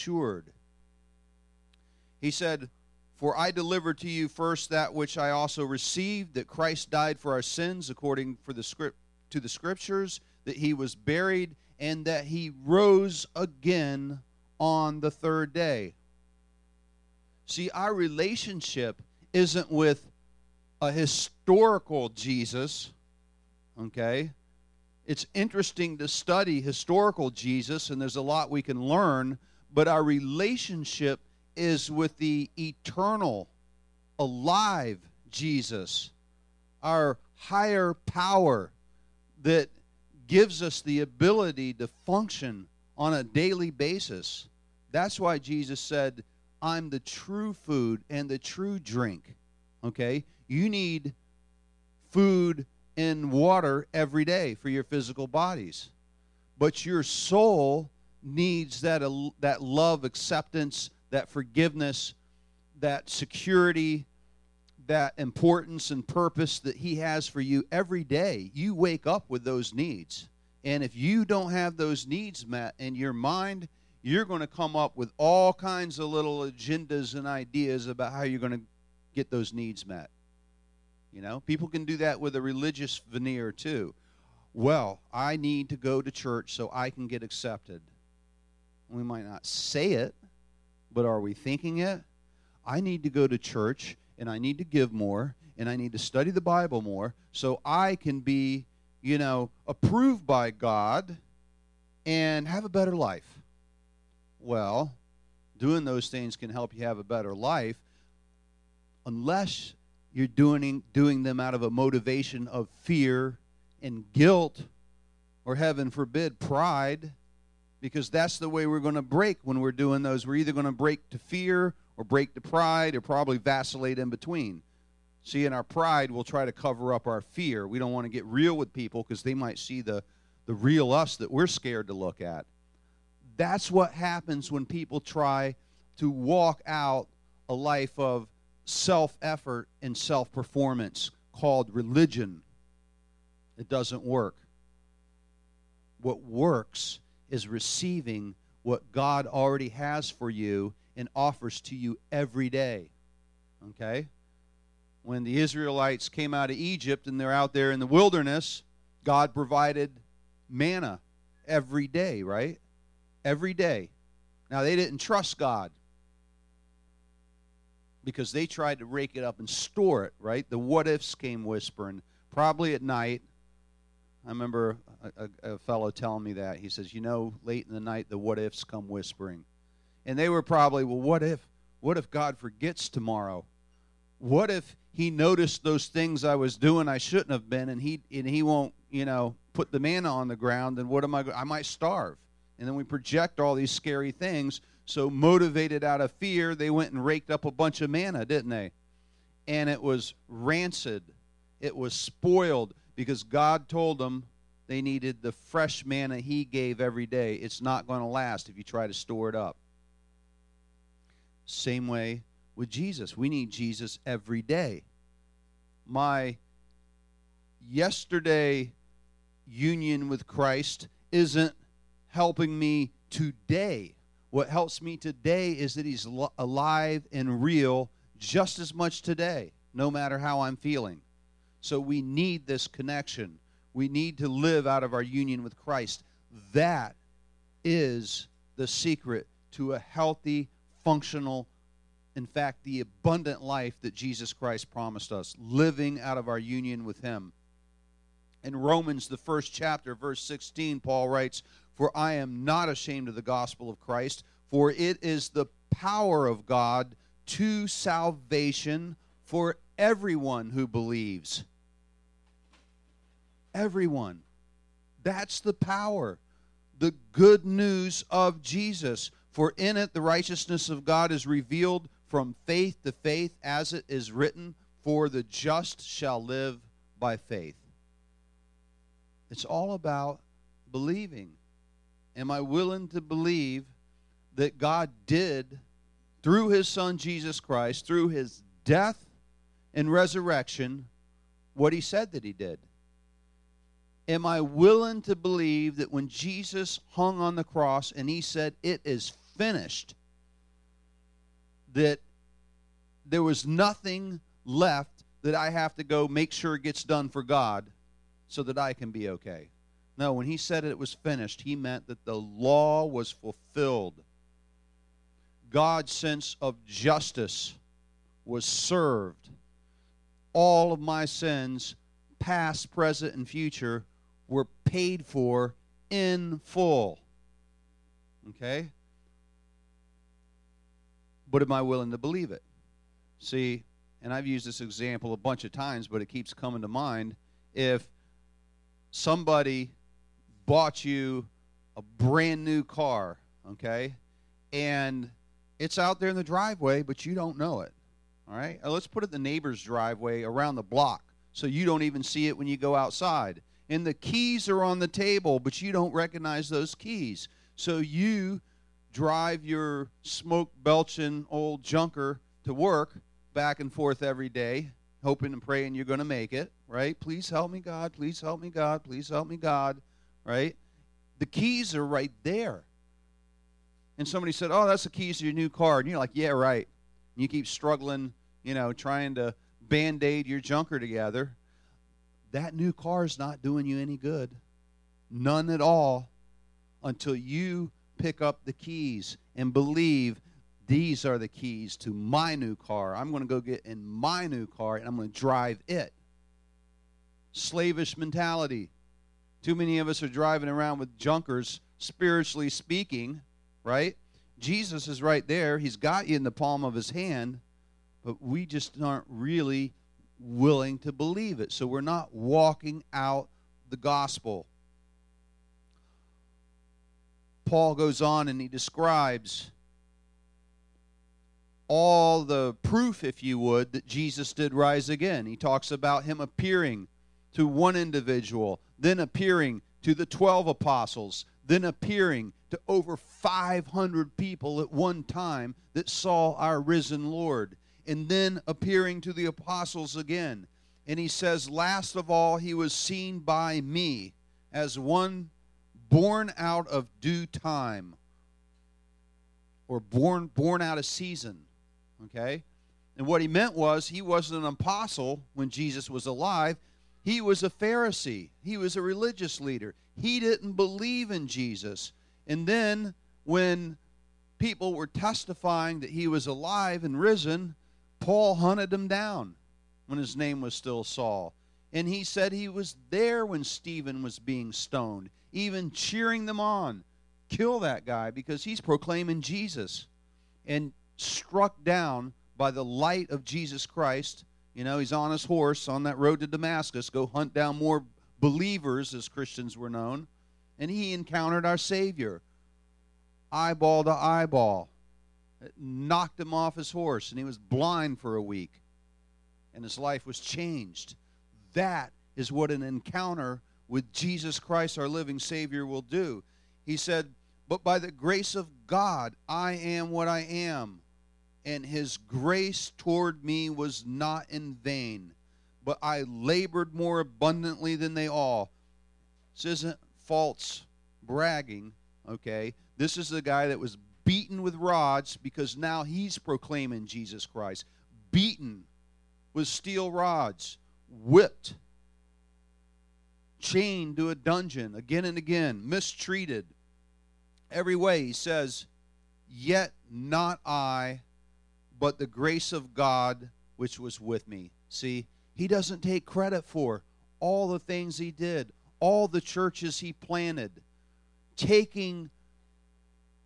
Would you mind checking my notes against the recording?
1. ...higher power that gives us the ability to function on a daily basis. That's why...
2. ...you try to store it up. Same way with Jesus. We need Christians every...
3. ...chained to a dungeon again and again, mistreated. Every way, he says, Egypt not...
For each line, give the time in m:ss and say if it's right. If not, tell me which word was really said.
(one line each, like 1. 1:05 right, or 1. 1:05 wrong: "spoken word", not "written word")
1. 0:37 right
2. 3:28 wrong: "Jesus", not "Christians"
3. 8:53 wrong: "Yet", not "Egypt".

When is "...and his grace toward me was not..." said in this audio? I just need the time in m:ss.
8:31.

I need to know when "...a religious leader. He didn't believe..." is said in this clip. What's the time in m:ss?
7:38.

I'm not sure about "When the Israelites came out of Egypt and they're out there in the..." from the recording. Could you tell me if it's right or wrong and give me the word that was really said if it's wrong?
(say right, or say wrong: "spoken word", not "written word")
right.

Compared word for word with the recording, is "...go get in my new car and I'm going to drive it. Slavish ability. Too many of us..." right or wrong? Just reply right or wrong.
wrong.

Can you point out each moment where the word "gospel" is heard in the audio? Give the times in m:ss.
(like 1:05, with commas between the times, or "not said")
4:13, 6:53.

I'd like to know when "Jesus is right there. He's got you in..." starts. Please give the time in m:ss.
6:44.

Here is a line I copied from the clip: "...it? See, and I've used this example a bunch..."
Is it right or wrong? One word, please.
right.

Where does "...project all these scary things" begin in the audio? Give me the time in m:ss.
3:12.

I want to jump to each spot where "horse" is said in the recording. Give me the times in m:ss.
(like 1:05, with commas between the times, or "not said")
8:05, 8:16.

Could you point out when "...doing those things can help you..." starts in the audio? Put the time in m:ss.
1:45.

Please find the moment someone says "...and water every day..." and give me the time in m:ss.
0:52.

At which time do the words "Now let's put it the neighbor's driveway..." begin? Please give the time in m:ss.
5:48.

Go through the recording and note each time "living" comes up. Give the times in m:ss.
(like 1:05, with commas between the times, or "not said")
4:05, 8:24.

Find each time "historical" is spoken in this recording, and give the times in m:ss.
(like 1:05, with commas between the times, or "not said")
0:20, 0:26.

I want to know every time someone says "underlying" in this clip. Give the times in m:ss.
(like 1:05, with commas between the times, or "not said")
not said.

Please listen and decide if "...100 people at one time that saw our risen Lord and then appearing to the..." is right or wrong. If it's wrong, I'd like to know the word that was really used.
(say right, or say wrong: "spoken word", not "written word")
wrong: "500", not "100".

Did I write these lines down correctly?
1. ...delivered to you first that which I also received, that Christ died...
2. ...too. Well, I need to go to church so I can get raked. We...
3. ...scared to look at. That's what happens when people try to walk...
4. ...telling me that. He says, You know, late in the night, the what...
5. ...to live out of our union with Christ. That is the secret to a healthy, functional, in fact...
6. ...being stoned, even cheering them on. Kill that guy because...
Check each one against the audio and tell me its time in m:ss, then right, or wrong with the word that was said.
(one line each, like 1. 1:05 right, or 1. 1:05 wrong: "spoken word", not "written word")
1. 0:03 right
2. 1:23 wrong: "accepted", not "raked"
3. 2:11 right
4. 2:55 right
5. 3:54 right
6. 7:54 right.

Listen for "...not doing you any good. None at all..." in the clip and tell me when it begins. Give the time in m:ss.
6:23.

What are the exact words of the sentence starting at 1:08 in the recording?
You wake up with those needs.